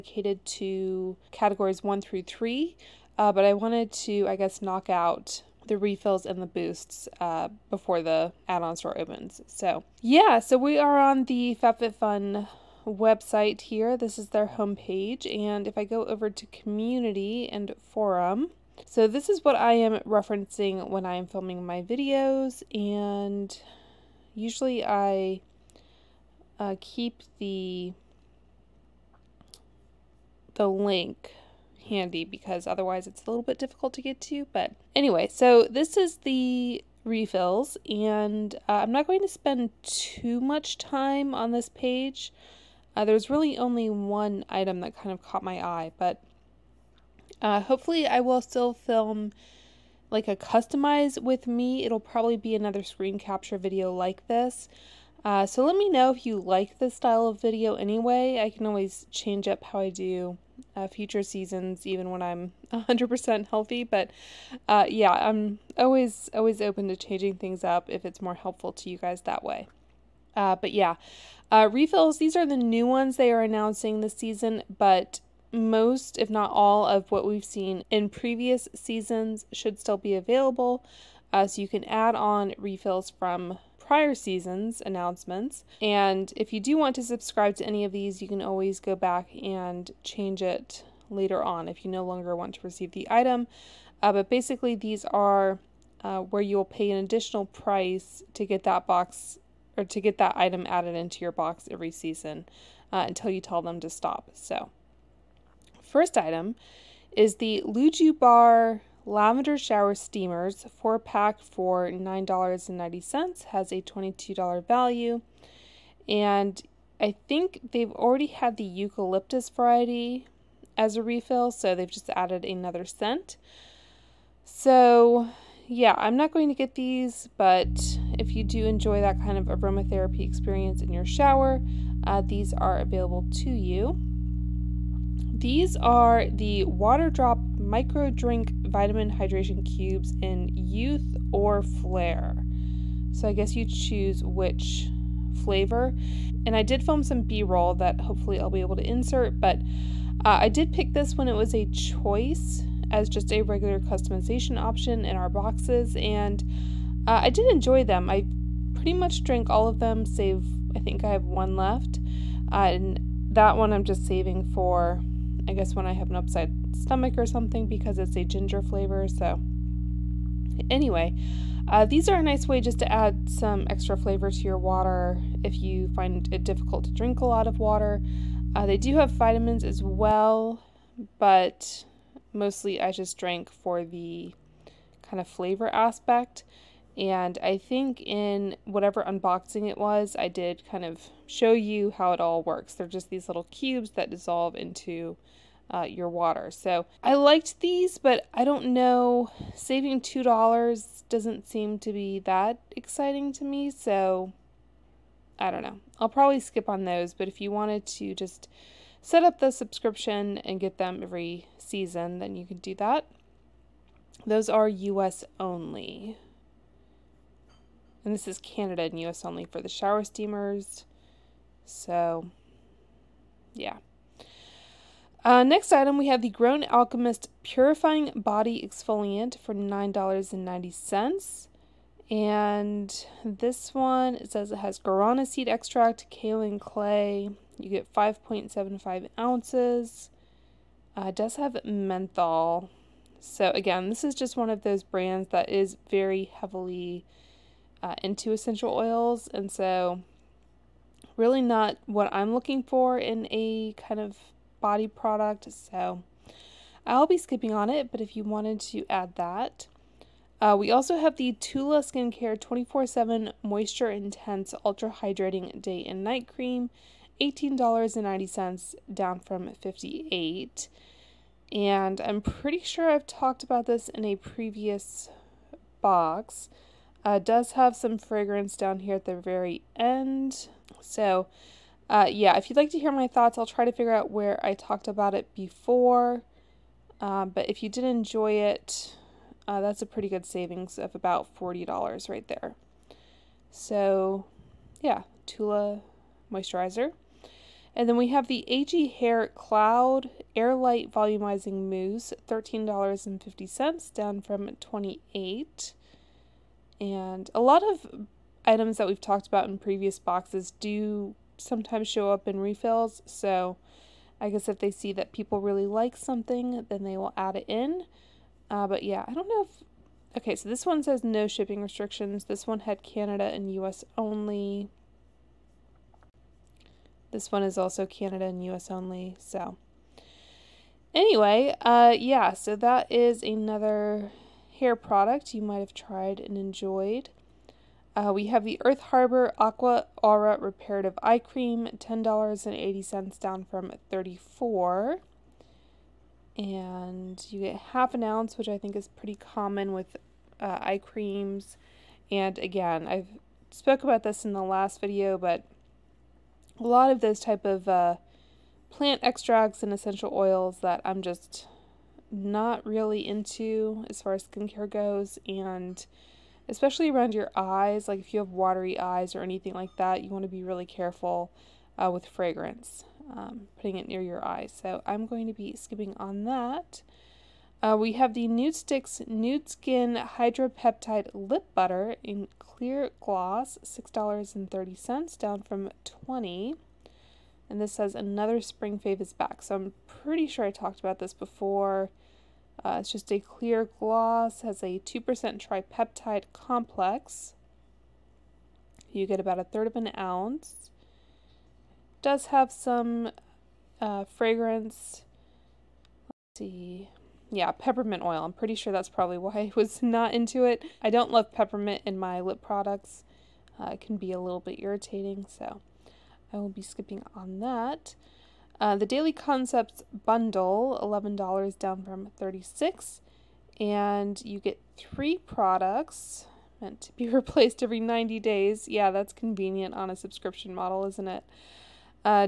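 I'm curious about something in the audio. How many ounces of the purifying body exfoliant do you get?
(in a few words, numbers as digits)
5.75 ounces.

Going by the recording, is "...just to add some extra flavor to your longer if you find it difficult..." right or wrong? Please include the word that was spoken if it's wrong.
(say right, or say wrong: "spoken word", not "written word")
wrong: "water", not "longer".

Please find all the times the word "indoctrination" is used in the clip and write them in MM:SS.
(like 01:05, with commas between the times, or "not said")
not said.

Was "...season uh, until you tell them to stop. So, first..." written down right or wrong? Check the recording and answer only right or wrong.
right.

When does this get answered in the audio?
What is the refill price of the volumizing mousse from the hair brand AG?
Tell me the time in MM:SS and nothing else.
05:02.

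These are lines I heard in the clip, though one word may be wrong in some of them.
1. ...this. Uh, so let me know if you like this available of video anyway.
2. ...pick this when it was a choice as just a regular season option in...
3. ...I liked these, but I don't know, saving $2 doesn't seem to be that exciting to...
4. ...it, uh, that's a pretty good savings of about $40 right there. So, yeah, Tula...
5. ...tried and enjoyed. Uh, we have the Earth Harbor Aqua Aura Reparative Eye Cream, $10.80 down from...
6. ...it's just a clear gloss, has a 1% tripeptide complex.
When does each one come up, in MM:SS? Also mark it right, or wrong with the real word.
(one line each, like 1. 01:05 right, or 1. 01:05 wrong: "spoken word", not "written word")
1. 00:54 wrong: "style", not "available"
2. 02:30 wrong: "customization", not "season"
3. 03:17 right
4. 04:48 right
5. 05:35 right
6. 06:32 wrong: "2", not "1".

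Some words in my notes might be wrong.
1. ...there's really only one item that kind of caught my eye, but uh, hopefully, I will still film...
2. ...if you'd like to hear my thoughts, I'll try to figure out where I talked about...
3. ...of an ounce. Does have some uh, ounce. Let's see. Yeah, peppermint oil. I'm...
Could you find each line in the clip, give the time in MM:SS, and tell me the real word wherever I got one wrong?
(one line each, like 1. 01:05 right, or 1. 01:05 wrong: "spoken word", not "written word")
1. 00:43 right
2. 04:42 right
3. 06:39 wrong: "fragrance", not "ounce".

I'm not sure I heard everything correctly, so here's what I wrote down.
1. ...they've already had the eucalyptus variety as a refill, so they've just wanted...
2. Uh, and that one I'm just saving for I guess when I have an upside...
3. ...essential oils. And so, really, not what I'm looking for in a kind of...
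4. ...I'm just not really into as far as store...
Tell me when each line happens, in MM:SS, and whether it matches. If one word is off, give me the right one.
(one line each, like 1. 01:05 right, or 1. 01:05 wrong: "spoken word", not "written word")
1. 01:57 wrong: "added", not "wanted"
2. 02:42 right
3. 04:08 right
4. 06:00 wrong: "skincare", not "store".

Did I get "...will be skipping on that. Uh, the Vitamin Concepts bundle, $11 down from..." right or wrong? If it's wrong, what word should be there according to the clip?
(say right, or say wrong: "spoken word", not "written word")
wrong: "Daily", not "Vitamin".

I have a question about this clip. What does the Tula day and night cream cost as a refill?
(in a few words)
$18.90.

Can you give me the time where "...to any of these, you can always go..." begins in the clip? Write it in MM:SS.
01:27.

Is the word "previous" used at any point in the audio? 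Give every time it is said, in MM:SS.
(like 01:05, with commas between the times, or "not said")
01:18, 04:34, 05:09.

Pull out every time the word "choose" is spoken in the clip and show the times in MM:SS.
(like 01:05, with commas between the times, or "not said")
02:23.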